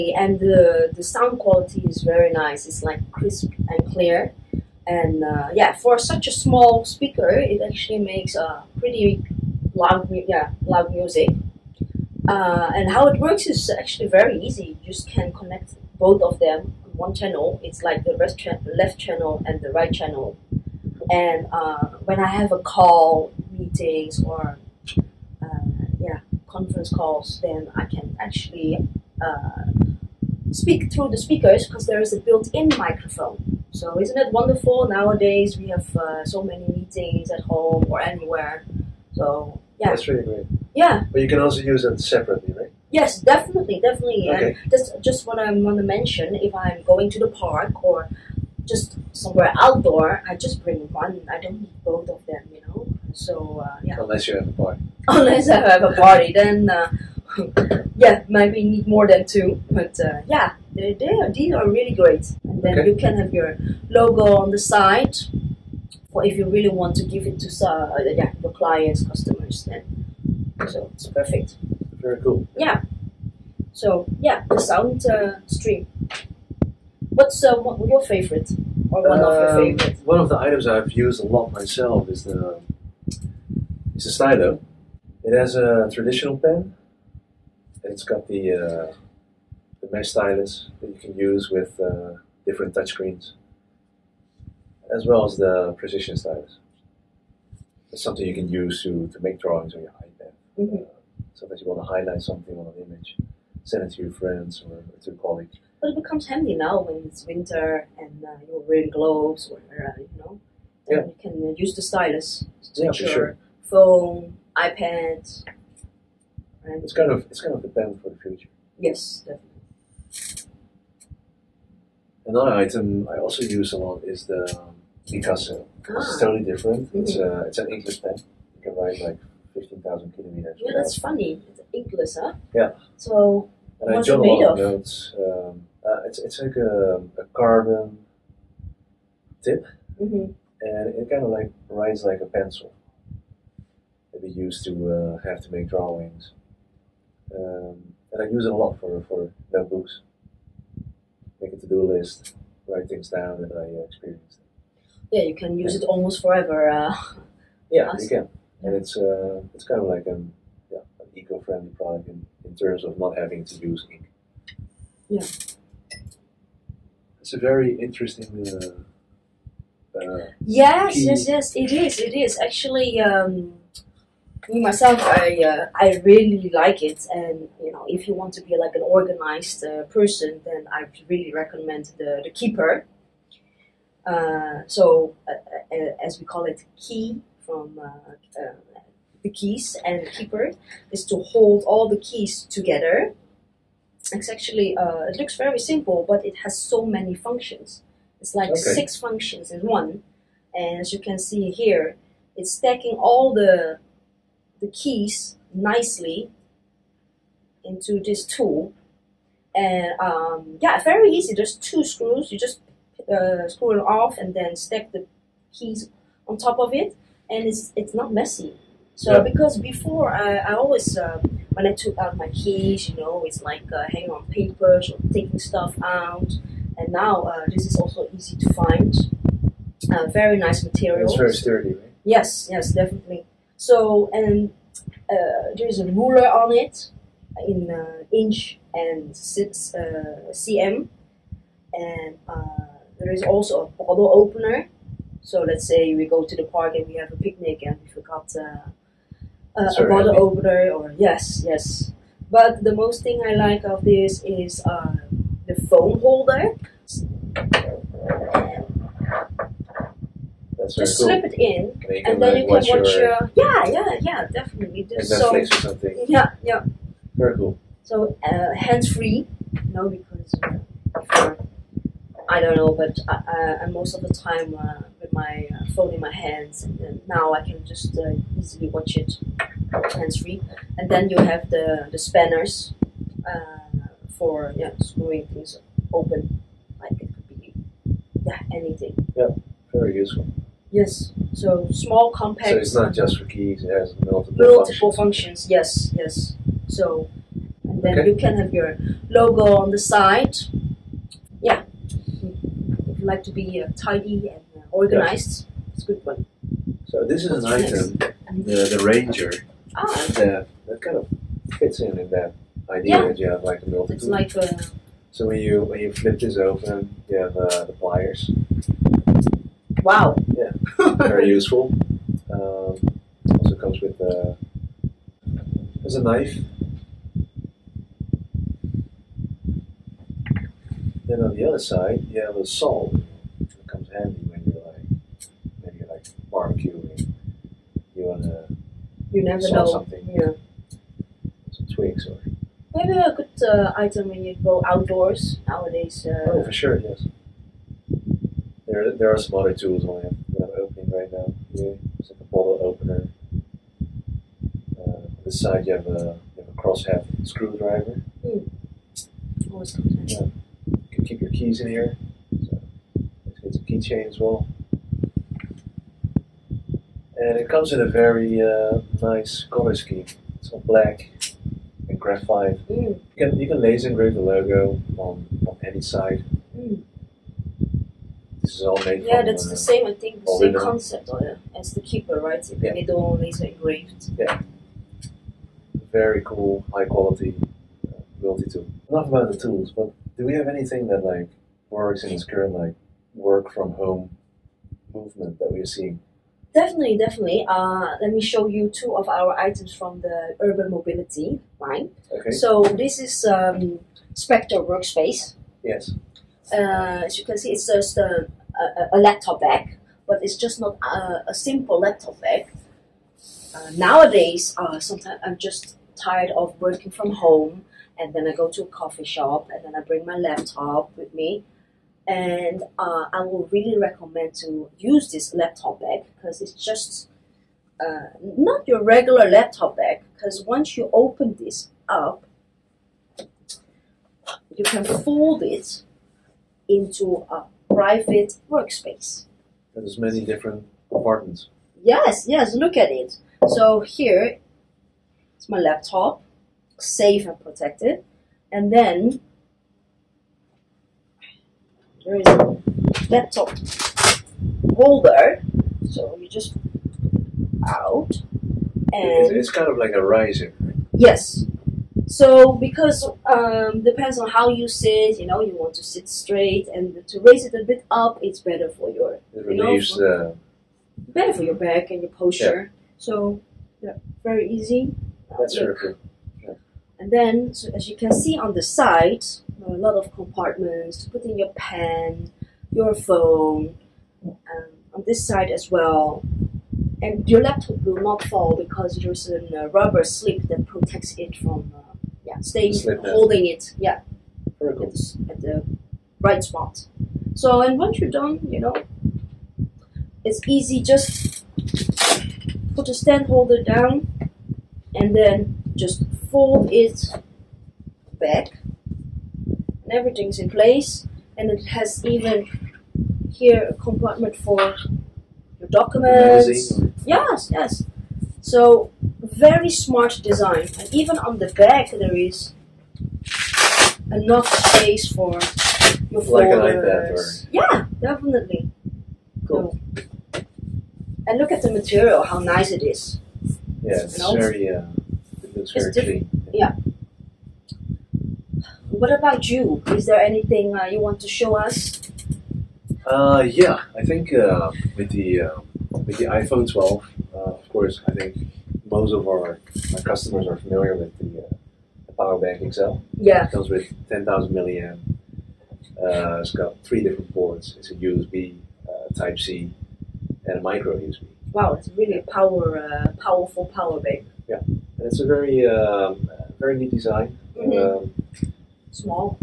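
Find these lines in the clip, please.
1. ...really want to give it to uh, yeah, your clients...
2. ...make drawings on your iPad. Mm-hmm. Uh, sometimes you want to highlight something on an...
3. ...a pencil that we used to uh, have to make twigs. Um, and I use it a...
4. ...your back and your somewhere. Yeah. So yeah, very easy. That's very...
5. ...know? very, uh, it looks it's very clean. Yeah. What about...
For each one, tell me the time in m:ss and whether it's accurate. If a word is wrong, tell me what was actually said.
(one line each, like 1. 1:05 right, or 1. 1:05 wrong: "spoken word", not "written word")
1. 1:06 right
2. 1:39 right
3. 2:22 wrong: "drawings", not "twigs"
4. 7:51 wrong: "posture", not "somewhere"
5. 8:54 right.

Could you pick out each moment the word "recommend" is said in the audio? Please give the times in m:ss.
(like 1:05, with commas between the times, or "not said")
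3:01, 7:03.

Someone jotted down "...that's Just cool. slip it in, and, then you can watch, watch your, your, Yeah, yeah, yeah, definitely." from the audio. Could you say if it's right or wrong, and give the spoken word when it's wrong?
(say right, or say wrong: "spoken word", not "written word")
right.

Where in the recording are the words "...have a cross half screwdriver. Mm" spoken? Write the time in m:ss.
5:56.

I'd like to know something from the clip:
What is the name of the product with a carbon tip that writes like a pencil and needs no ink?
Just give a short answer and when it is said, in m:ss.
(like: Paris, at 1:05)
Picasso, at 2:05.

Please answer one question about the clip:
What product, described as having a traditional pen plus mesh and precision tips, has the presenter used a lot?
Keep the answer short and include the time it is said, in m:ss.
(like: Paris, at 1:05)
Stylo, at 1:24.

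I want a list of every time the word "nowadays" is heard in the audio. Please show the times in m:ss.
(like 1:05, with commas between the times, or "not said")
0:34, 5:45, 6:53.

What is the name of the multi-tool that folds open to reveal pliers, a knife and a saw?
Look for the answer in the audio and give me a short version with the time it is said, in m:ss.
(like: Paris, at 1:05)
Ranger, at 5:08.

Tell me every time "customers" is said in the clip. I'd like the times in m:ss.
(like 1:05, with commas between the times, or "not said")
1:09, 9:10.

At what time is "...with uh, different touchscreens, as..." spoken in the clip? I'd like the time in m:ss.
1:31.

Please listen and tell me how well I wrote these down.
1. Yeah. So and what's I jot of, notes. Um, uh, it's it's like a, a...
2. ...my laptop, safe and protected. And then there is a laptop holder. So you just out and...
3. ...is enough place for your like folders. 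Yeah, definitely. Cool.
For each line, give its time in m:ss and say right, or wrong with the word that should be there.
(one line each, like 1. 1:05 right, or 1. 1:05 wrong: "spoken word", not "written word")
1. 2:12 right
2. 7:25 right
3. 8:42 wrong: "space", not "place".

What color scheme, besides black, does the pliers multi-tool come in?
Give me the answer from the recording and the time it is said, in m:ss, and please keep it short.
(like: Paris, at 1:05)
Graphite, at 6:11.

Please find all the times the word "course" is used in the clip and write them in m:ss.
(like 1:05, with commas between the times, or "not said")
9:07.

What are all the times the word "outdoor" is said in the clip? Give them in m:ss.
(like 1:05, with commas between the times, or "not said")
0:49, 5:44.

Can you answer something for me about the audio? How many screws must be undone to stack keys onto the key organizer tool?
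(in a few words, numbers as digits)
2.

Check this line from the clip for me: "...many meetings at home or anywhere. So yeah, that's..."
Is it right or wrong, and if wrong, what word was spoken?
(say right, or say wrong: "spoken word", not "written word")
right.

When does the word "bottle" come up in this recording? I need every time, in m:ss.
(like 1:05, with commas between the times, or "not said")
4:03, 4:09, 5:52.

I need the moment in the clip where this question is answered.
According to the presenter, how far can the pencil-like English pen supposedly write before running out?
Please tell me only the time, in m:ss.
2:09.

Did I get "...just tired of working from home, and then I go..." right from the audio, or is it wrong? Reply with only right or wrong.
right.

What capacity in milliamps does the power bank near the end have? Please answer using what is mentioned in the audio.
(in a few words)
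10,000 milliamp.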